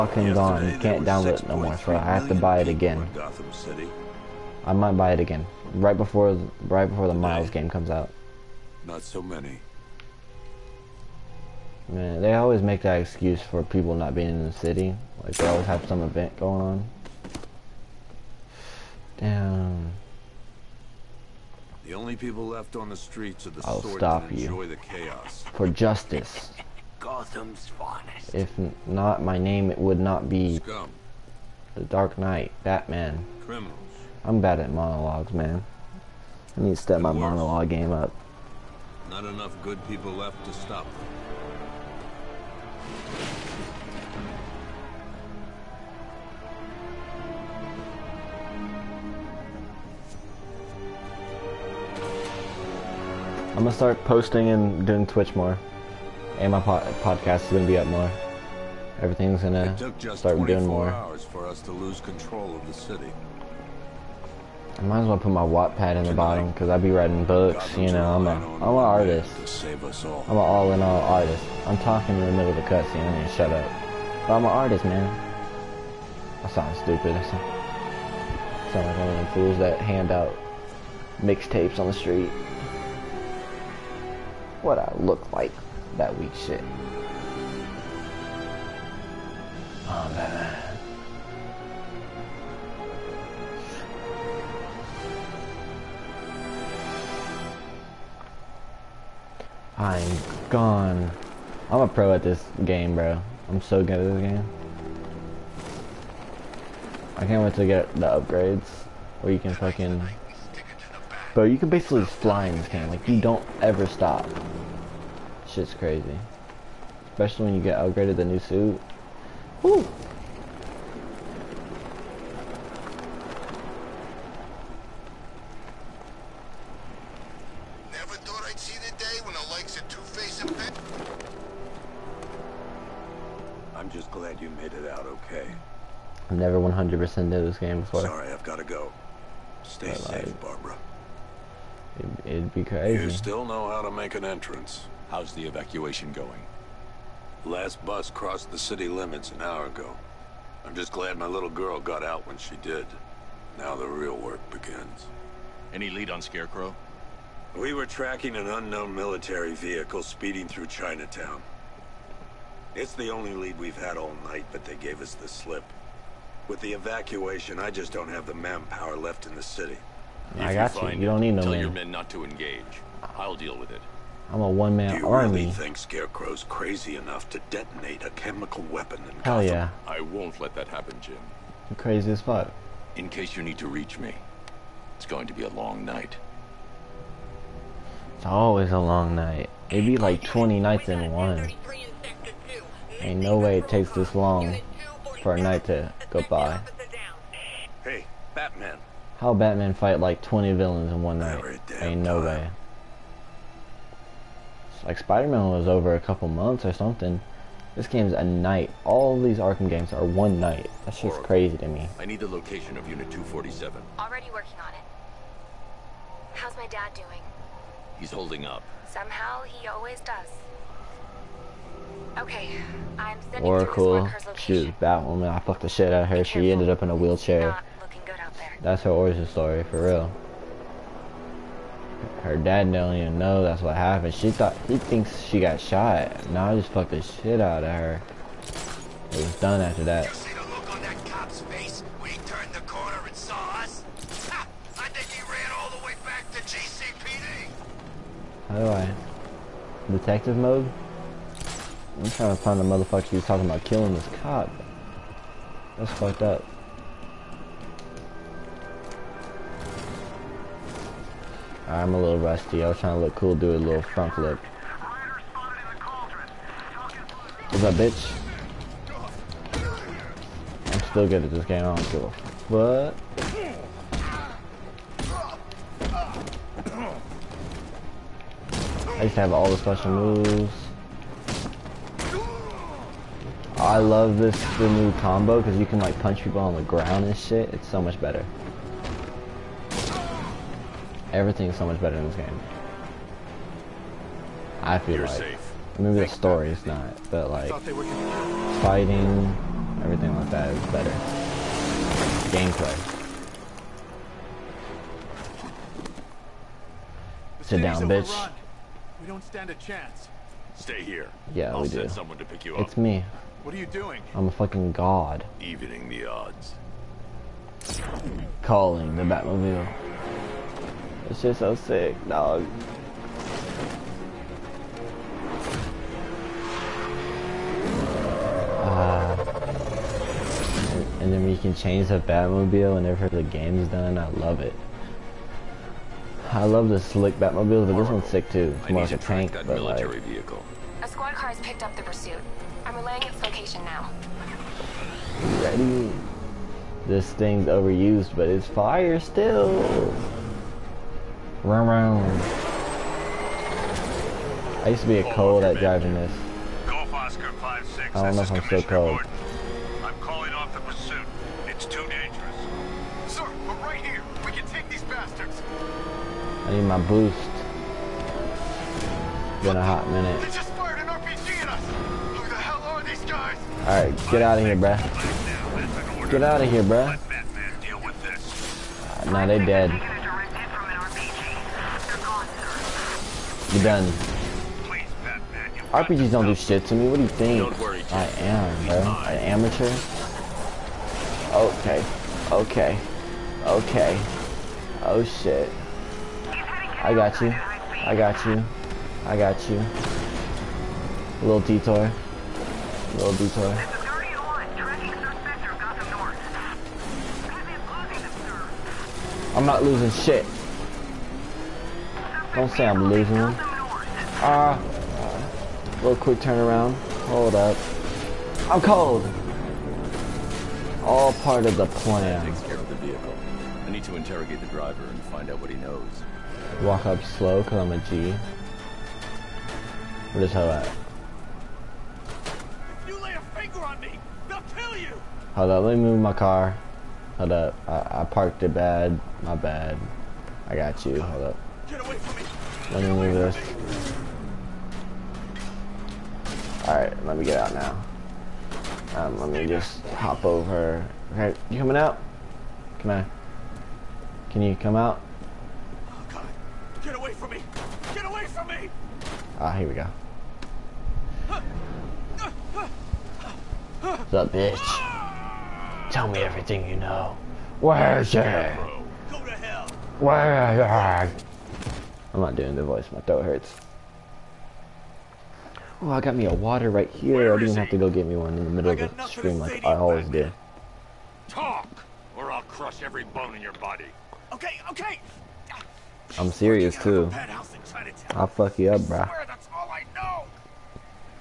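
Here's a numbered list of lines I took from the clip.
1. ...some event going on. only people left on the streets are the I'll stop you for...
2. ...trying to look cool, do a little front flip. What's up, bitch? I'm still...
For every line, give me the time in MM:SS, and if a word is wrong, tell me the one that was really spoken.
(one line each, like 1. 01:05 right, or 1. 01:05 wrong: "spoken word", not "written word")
1. 00:15 right
2. 04:22 right.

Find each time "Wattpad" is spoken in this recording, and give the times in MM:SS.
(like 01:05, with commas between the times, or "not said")
01:05.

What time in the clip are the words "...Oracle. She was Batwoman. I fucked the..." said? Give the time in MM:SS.
03:43.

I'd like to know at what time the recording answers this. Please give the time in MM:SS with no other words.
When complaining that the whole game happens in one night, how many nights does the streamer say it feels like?
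03:10.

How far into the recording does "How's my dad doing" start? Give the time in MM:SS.
03:36.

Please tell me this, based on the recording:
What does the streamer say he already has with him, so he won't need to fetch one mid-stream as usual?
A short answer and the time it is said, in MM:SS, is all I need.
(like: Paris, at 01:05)
A water, at 07:56.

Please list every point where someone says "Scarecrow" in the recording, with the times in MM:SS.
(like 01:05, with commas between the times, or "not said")
02:36, 02:55.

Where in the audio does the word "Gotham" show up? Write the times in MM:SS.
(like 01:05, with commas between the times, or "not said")
02:59.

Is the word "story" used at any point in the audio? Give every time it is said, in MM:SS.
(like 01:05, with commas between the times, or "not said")
03:49, 04:56.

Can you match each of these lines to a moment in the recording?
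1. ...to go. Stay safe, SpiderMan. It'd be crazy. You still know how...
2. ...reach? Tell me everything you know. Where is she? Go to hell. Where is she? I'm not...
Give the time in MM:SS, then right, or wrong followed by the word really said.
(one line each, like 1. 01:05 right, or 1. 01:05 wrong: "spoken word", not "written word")
1. 02:18 wrong: "Barbara", not "SpiderMan"
2. 07:44 wrong: "bitch", not "reach".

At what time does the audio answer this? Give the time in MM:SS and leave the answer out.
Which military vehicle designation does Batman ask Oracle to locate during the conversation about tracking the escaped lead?
03:32.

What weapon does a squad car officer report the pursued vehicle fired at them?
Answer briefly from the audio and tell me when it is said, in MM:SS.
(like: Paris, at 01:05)
RPG, at 06:10.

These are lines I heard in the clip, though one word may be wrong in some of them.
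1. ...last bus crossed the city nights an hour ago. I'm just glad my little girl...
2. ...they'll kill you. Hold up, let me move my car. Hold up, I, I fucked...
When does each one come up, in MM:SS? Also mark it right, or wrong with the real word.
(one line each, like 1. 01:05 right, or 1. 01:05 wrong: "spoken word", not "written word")
1. 02:27 wrong: "limits", not "nights"
2. 07:14 wrong: "parked", not "fucked".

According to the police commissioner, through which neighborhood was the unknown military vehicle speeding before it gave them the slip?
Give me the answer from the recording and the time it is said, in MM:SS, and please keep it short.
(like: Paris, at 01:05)
Chinatown, at 02:40.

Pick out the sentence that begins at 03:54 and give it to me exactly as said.
She thought he thinks she got shot.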